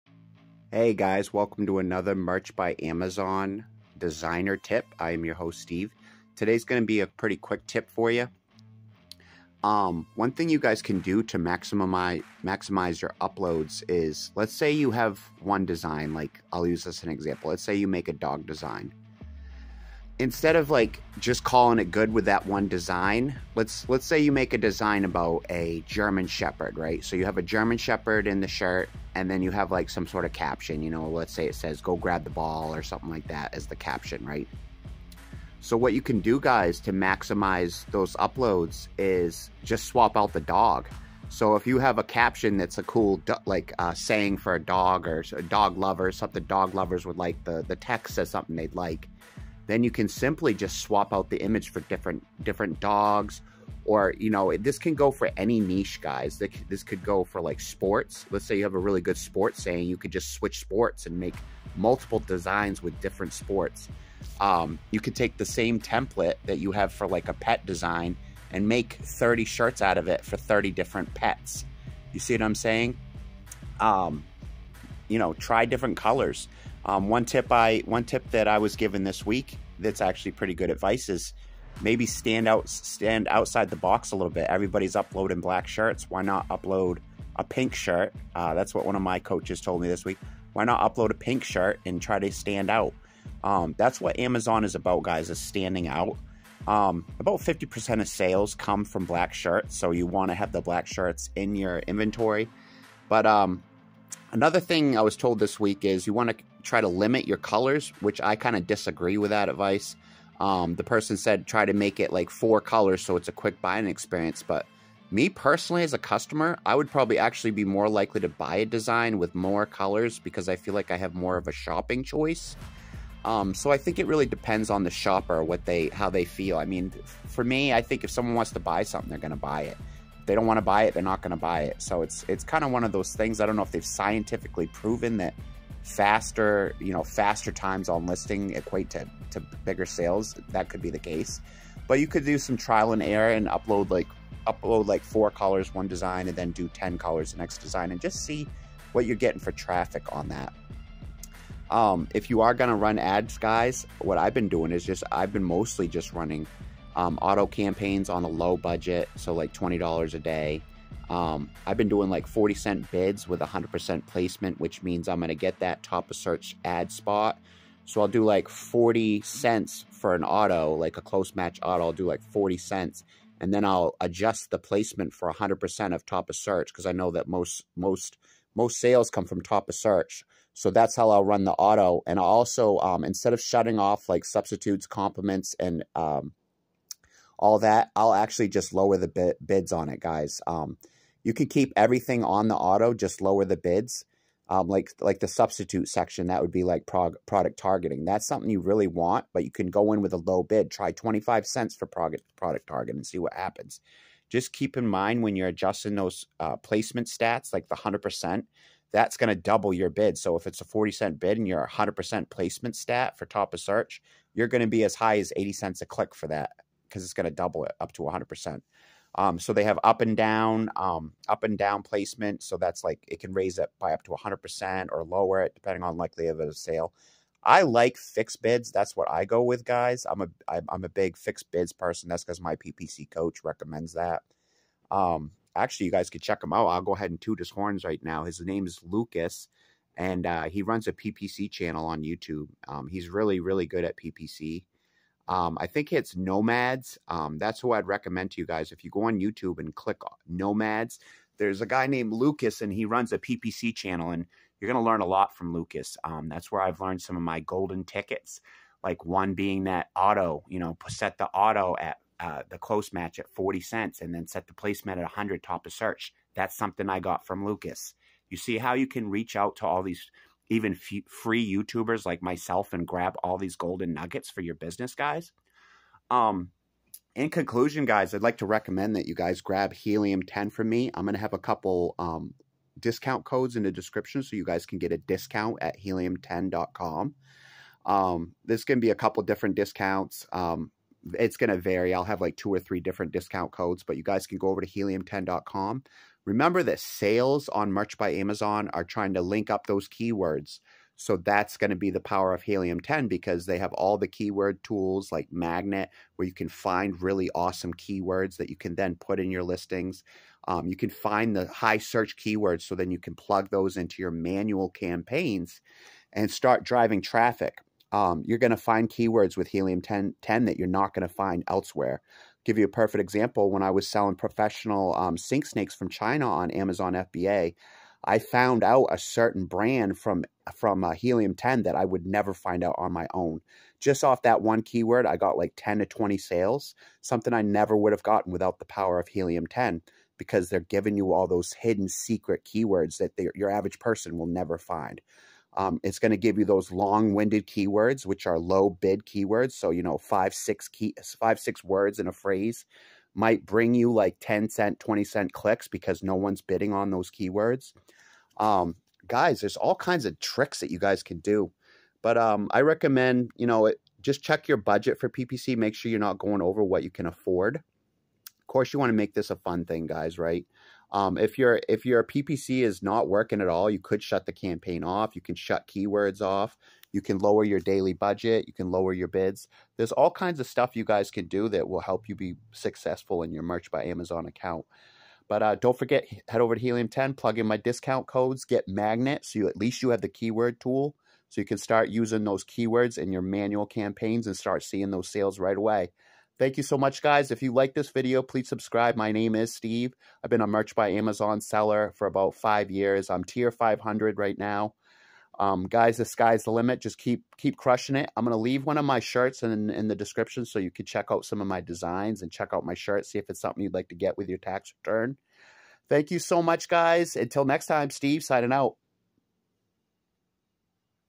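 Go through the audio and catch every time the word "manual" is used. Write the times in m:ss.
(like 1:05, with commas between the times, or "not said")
5:14, 6:33.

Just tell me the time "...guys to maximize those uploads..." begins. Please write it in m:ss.
0:36.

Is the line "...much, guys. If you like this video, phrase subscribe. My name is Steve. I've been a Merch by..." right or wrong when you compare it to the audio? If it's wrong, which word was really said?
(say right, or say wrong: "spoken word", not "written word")
wrong: "please", not "phrase".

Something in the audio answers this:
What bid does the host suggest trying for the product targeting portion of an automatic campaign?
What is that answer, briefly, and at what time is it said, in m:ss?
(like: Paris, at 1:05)
25 cents, at 3:20.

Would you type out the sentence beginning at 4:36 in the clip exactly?
Um, in conclusion, guys, I'd like to recommend that you guys grab Helium 10 from me.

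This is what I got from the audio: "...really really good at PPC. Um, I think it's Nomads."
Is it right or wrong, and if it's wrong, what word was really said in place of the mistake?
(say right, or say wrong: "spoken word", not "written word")
right.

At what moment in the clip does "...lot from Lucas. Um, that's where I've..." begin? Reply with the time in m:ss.
4:15.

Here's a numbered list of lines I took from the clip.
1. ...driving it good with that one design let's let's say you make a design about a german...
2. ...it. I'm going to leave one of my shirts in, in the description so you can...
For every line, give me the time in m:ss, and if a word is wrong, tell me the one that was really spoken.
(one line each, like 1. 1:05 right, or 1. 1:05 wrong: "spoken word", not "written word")
1. 0:21 wrong: "calling", not "driving"
2. 6:47 right.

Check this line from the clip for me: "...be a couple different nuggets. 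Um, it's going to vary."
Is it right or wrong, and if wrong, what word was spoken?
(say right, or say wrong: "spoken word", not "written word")
wrong: "discounts", not "nuggets".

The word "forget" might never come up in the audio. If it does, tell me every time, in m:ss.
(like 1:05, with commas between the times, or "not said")
6:25.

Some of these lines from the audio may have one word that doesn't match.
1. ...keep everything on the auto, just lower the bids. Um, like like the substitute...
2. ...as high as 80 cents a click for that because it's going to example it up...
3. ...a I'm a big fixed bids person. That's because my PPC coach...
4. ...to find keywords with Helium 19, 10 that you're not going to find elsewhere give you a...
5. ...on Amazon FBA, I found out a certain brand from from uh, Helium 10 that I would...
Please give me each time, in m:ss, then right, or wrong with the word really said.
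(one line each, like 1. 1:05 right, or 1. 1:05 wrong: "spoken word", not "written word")
1. 3:11 right
2. 3:34 wrong: "double", not "example"
3. 3:50 right
4. 5:18 wrong: "10", not "19"
5. 5:26 right.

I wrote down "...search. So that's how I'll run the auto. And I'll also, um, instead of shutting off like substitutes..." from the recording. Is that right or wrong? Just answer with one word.
right.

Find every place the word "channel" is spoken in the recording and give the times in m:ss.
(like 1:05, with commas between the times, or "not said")
4:01, 4:13.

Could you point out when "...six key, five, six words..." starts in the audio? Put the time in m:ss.
5:50.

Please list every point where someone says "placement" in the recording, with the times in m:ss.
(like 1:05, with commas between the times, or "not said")
2:44, 2:54, 3:26, 3:32, 3:41, 4:24.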